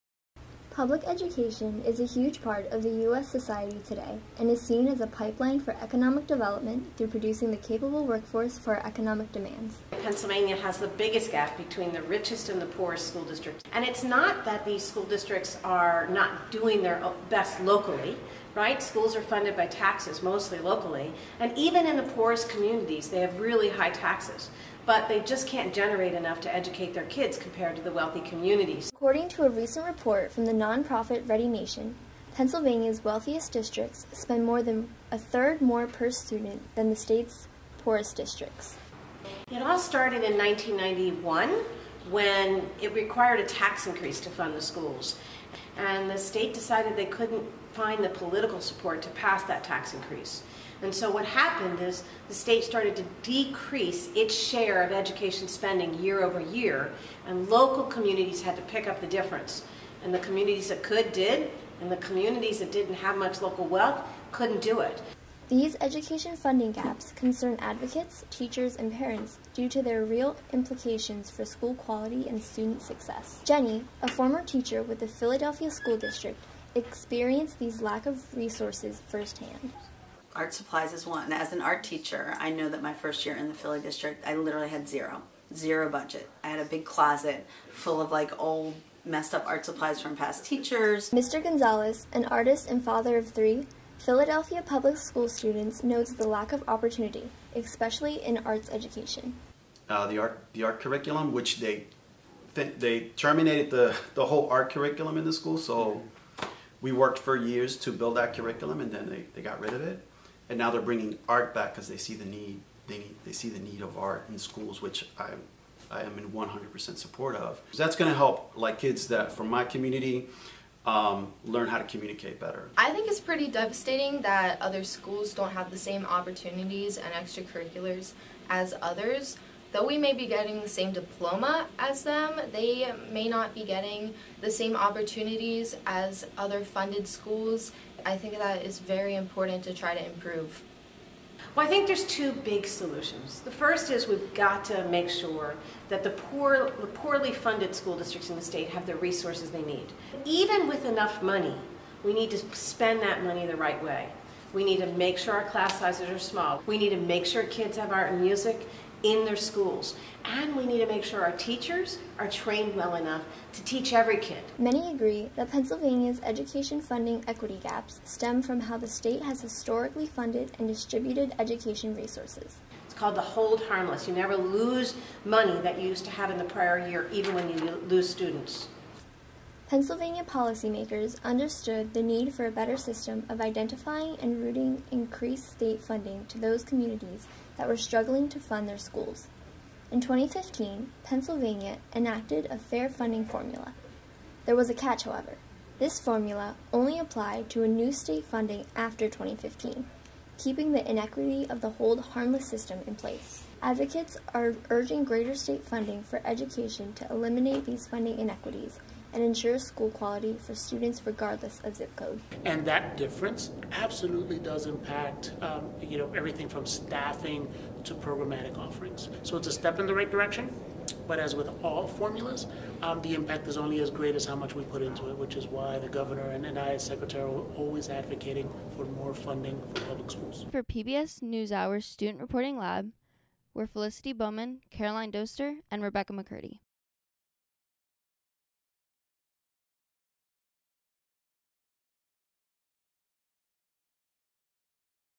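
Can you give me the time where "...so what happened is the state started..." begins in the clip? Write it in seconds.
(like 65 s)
50 s.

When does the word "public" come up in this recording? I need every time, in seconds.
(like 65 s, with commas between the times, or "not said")
0 s, 94 s, 229 s.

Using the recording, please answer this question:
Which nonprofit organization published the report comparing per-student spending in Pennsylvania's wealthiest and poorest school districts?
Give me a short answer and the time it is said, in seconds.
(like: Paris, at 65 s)
Ready Nation, at 31 s.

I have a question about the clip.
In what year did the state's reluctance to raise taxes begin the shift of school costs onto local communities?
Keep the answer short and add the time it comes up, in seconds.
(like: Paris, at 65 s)
1991, at 40 s.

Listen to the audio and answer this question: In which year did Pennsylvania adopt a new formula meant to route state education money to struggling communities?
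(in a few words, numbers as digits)
2015.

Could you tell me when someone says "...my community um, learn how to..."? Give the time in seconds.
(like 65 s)
119 s.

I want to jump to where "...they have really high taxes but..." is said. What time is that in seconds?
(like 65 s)
23 s.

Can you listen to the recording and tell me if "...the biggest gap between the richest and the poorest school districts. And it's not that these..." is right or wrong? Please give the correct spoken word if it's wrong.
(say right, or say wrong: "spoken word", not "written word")
right.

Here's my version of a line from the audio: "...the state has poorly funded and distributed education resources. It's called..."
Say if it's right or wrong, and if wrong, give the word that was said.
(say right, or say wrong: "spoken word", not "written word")
wrong: "historically", not "poorly".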